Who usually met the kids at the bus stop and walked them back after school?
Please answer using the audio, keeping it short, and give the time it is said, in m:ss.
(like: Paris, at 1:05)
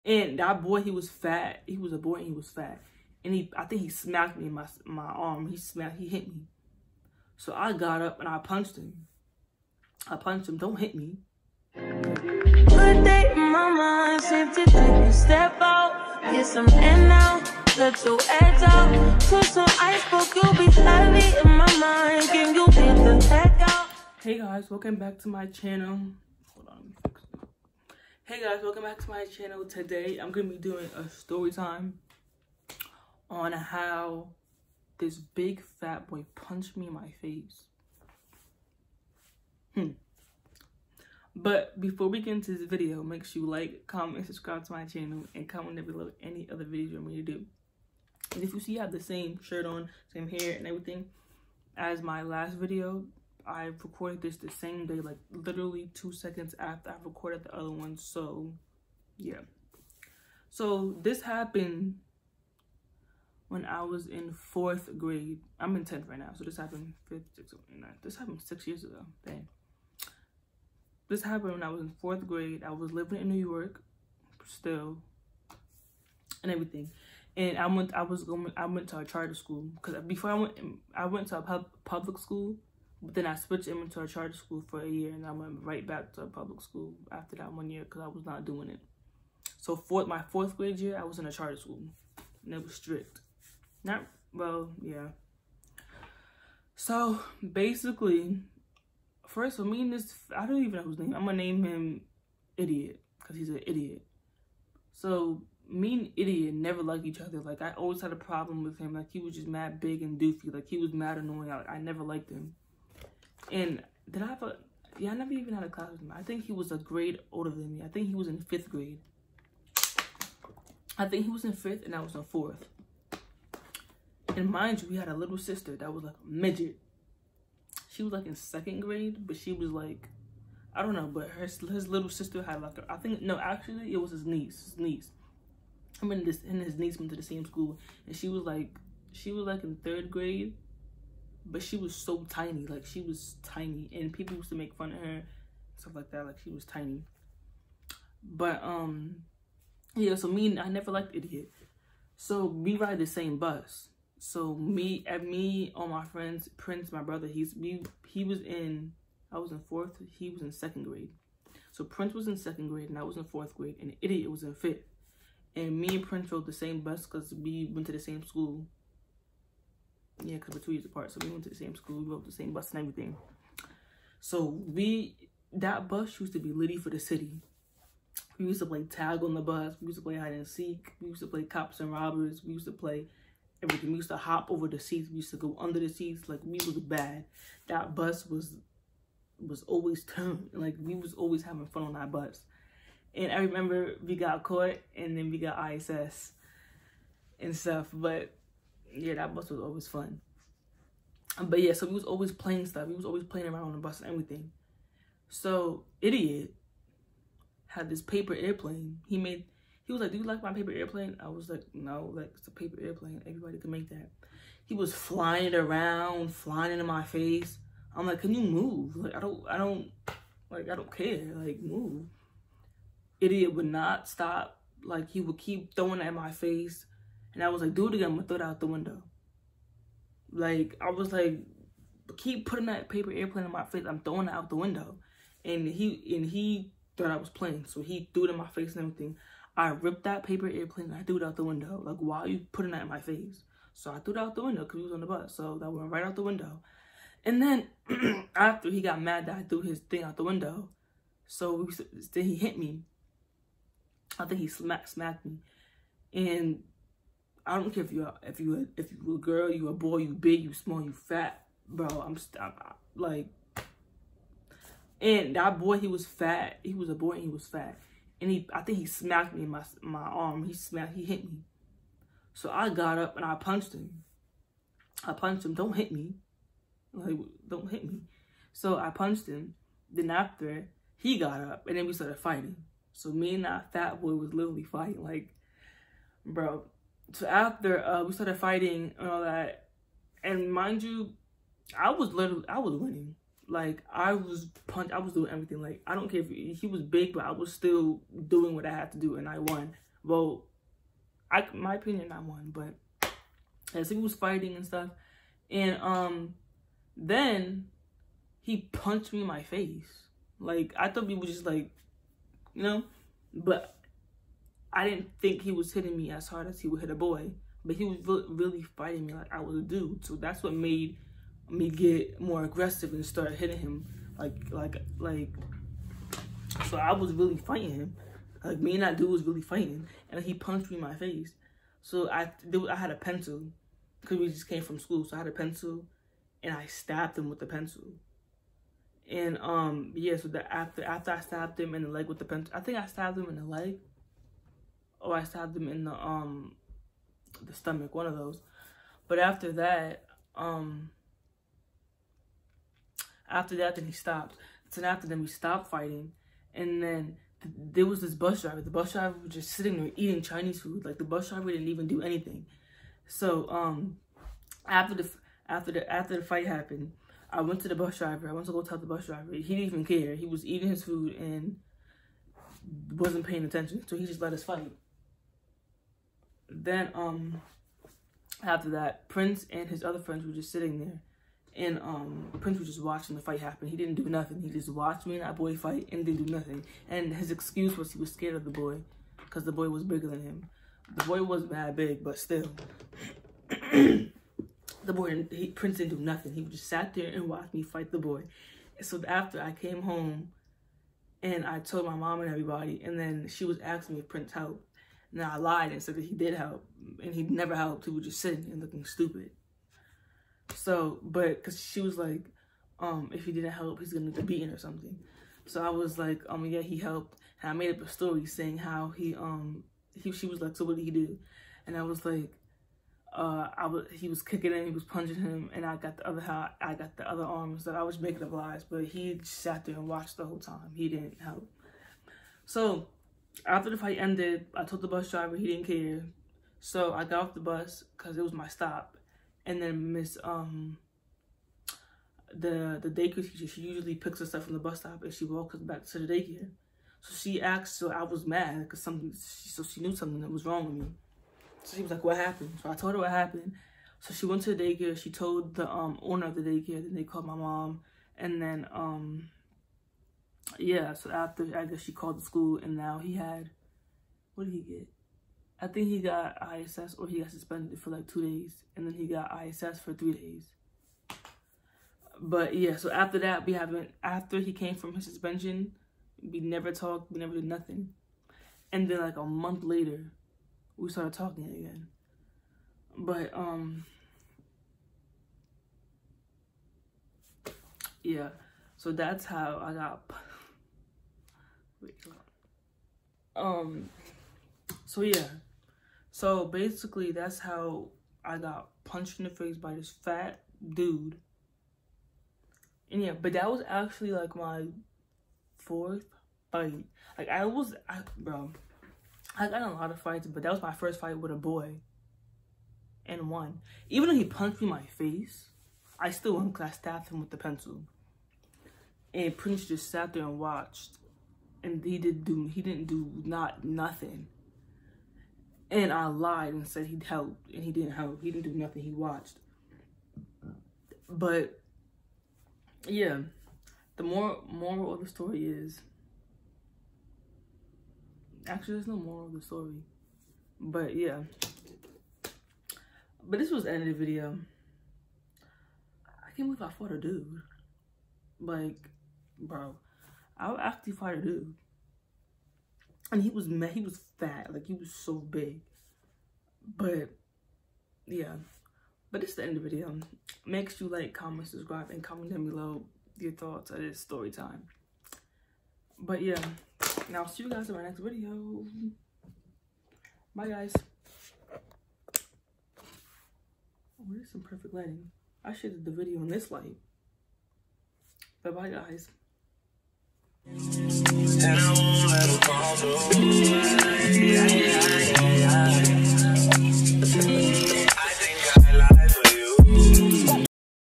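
the daycare teacher, at 7:22.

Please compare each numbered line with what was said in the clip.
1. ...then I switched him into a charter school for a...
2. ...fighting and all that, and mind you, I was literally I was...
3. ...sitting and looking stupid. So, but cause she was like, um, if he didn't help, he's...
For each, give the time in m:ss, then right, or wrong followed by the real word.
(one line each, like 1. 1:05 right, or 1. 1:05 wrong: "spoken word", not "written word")
1. 1:23 right
2. 4:48 right
3. 6:48 right.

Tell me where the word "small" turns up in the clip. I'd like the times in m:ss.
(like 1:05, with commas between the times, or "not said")
4:20.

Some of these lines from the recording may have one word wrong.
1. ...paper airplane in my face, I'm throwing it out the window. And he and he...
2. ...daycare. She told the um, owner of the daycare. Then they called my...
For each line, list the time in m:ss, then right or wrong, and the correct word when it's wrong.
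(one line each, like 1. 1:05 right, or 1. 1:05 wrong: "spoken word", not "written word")
1. 3:52 right
2. 7:34 right.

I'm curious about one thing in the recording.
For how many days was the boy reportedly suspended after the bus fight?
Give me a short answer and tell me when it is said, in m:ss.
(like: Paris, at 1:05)
2, at 7:48.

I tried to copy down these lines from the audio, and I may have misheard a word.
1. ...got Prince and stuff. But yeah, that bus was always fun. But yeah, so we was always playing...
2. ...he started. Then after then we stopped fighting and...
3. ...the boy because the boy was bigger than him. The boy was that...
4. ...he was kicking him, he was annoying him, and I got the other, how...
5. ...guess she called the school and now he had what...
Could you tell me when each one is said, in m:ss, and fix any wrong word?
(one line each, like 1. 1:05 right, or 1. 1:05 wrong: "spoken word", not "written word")
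1. 3:15 wrong: "ISS", not "Prince"
2. 5:53 wrong: "stopped", not "started"
3. 6:28 right
4. 7:03 wrong: "punching", not "annoying"
5. 7:41 right.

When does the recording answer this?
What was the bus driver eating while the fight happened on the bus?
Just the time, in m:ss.
6:00.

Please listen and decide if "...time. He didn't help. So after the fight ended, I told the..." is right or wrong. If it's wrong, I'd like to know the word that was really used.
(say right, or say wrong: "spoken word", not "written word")
right.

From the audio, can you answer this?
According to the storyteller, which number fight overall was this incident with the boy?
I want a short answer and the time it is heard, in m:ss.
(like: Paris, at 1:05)
4th, at 8:25.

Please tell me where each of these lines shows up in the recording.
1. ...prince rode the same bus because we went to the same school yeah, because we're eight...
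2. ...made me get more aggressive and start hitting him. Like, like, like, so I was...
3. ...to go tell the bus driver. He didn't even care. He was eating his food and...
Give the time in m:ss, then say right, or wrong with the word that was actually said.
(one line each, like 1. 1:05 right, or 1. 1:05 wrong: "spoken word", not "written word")
1. 2:46 wrong: "two", not "eight"
2. 5:20 right
3. 6:08 right.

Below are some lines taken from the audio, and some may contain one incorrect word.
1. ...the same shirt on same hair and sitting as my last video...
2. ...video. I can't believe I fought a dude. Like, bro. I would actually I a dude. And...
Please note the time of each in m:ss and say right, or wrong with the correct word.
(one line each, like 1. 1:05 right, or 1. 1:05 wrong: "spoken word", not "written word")
1. 0:48 wrong: "everything", not "sitting"
2. 9:03 right.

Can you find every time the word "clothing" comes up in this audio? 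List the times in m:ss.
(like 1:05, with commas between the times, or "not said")
not said.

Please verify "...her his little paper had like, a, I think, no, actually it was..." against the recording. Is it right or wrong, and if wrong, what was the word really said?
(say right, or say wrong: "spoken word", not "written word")
wrong: "sister", not "paper".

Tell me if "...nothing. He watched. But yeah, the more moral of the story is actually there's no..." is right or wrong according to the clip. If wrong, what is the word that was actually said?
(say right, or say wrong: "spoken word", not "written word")
right.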